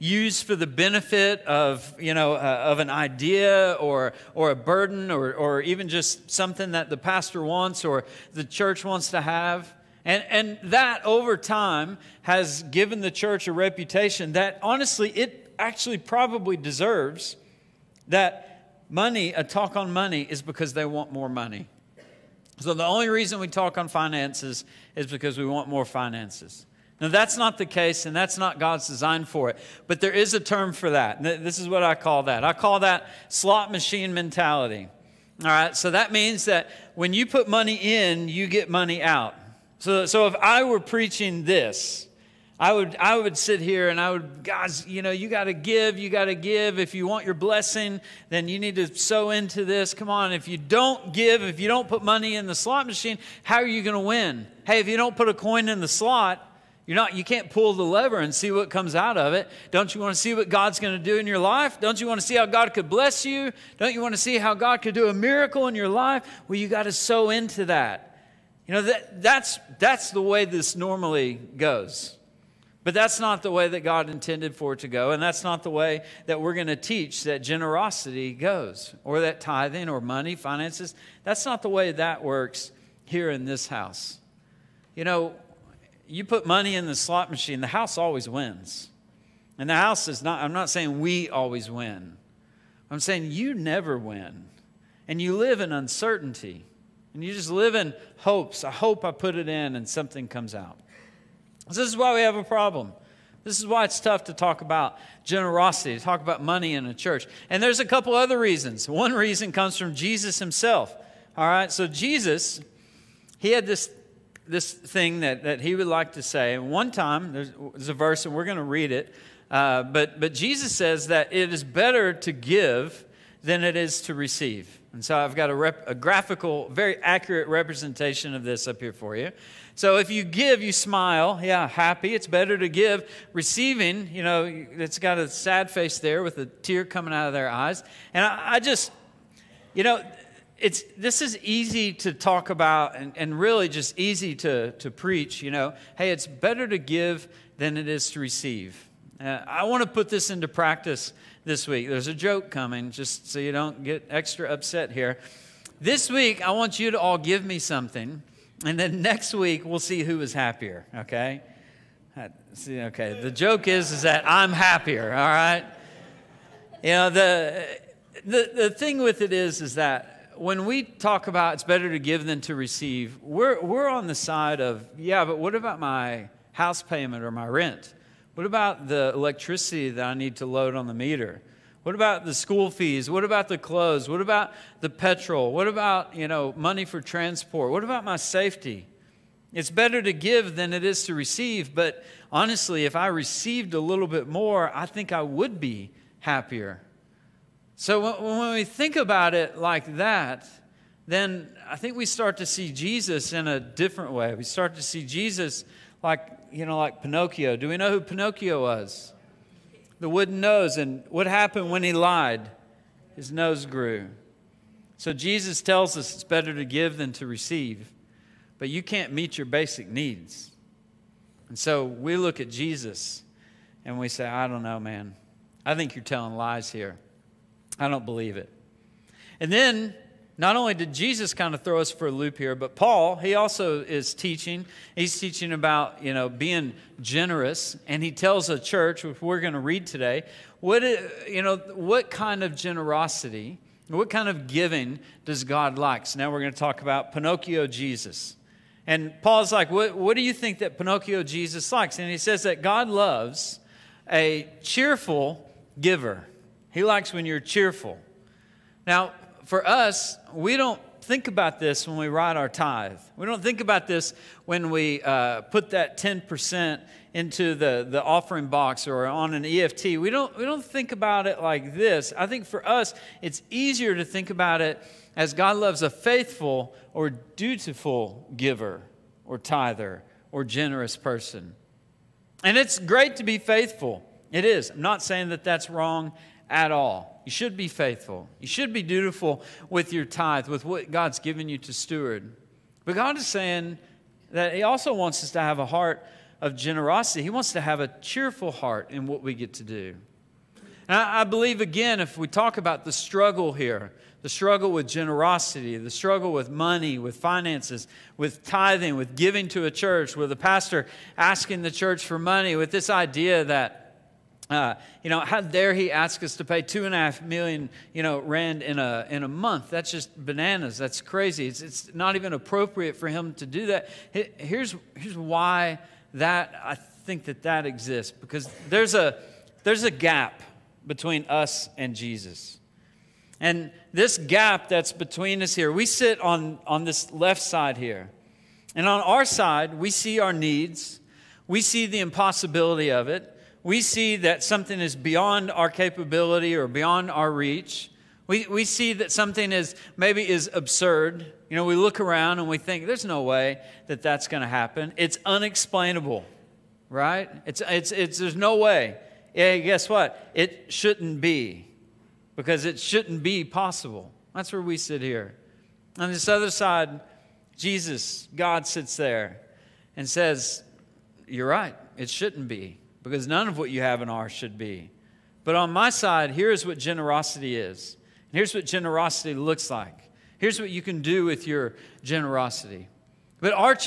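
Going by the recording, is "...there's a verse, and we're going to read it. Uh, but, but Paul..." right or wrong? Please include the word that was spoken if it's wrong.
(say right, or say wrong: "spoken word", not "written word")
wrong: "Jesus", not "Paul".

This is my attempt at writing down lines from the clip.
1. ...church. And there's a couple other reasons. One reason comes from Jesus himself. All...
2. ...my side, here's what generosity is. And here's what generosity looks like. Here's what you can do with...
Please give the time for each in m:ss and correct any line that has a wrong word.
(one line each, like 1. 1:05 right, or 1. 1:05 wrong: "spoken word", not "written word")
1. 1:46 right
2. 6:15 right.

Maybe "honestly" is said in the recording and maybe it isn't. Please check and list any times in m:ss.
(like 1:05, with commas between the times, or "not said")
0:14, 3:12.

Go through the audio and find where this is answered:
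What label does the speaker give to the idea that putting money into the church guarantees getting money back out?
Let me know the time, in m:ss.
0:33.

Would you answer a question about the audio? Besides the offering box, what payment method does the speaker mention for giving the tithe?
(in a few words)
EFT.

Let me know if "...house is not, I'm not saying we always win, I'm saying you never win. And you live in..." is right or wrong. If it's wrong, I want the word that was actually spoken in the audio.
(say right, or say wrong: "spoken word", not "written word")
right.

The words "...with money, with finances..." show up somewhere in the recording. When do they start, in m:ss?
5:06.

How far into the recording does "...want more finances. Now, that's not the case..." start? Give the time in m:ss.
0:25.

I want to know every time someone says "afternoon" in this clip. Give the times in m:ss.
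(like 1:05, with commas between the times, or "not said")
not said.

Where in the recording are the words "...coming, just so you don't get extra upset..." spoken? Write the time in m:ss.
2:32.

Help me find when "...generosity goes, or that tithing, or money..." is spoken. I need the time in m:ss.
1:17.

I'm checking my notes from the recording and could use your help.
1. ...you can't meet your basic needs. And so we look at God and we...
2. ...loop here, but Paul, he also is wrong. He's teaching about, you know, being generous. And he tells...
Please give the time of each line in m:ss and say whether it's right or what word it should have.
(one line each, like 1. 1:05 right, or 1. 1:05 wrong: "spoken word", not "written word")
1. 3:38 wrong: "Jesus", not "God"
2. 3:52 wrong: "teaching", not "wrong".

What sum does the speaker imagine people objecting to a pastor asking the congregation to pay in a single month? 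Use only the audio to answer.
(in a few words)
2.5 million rand.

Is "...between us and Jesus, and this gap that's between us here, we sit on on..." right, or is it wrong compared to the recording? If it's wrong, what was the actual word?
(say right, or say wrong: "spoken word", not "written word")
right.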